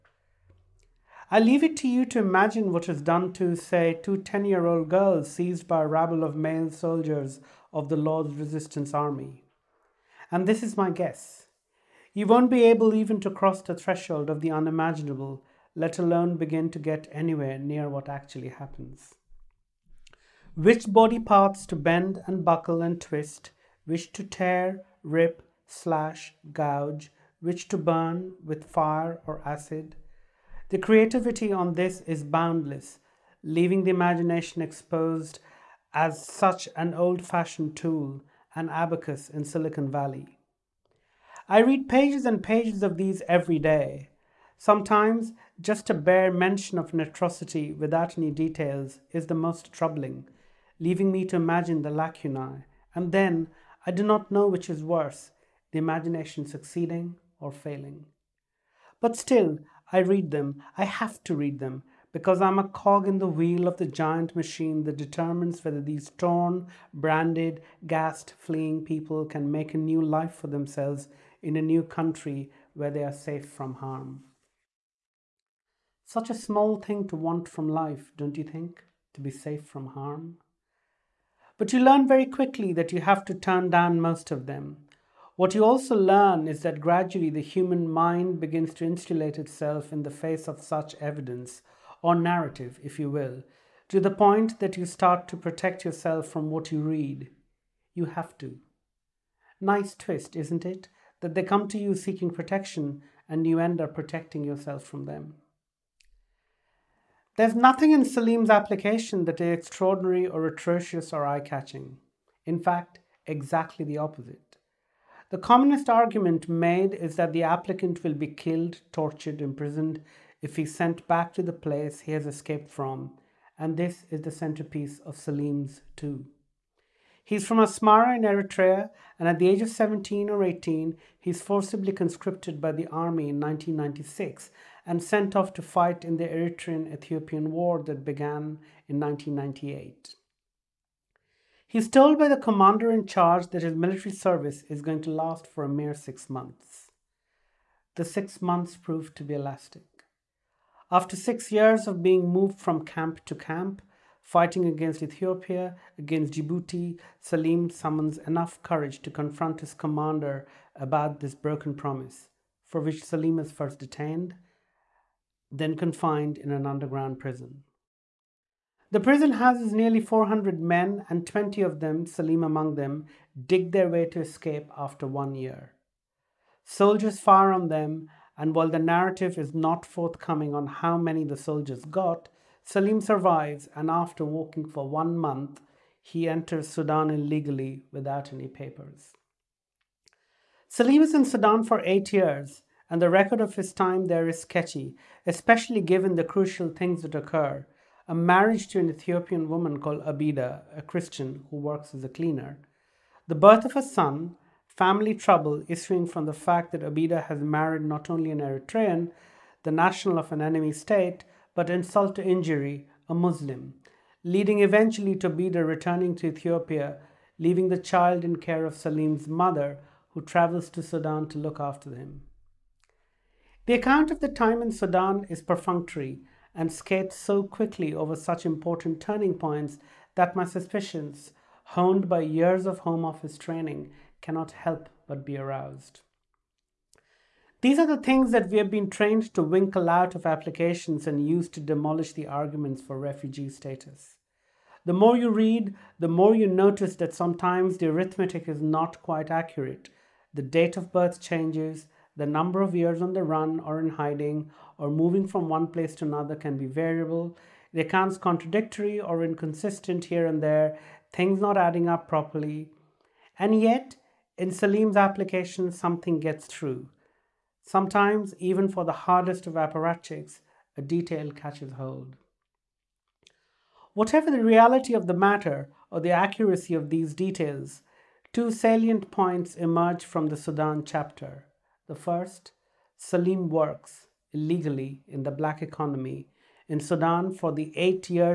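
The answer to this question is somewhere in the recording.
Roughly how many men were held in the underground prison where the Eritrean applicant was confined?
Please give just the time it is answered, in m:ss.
2:50.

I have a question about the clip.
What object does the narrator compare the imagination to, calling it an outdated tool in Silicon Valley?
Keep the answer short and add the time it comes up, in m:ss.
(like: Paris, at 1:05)
an abacus, at 0:38.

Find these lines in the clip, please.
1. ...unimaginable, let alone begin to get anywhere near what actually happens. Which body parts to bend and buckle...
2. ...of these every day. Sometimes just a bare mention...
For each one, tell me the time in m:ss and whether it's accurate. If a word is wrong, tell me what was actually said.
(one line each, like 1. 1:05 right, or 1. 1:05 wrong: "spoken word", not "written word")
1. 0:14 right
2. 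0:42 right.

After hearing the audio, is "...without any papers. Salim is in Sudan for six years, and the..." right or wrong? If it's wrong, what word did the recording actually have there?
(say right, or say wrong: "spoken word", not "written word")
wrong: "eight", not "six".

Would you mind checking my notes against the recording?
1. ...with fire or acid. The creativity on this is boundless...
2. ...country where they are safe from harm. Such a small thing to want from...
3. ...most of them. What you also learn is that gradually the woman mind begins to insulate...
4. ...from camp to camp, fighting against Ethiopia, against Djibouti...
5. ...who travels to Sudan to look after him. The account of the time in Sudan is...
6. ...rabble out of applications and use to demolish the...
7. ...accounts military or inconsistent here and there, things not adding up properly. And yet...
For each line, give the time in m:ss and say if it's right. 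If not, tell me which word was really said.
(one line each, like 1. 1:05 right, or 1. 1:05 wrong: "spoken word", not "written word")
1. 0:28 right
2. 1:11 right
3. 1:24 wrong: "human", not "woman"
4. 2:32 right
5. 3:40 right
6. 3:59 wrong: "winkle", not "rabble"
7. 4:17 wrong: "contradictory", not "military".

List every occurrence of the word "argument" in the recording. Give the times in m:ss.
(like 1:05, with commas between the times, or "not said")
1:55, 4:02.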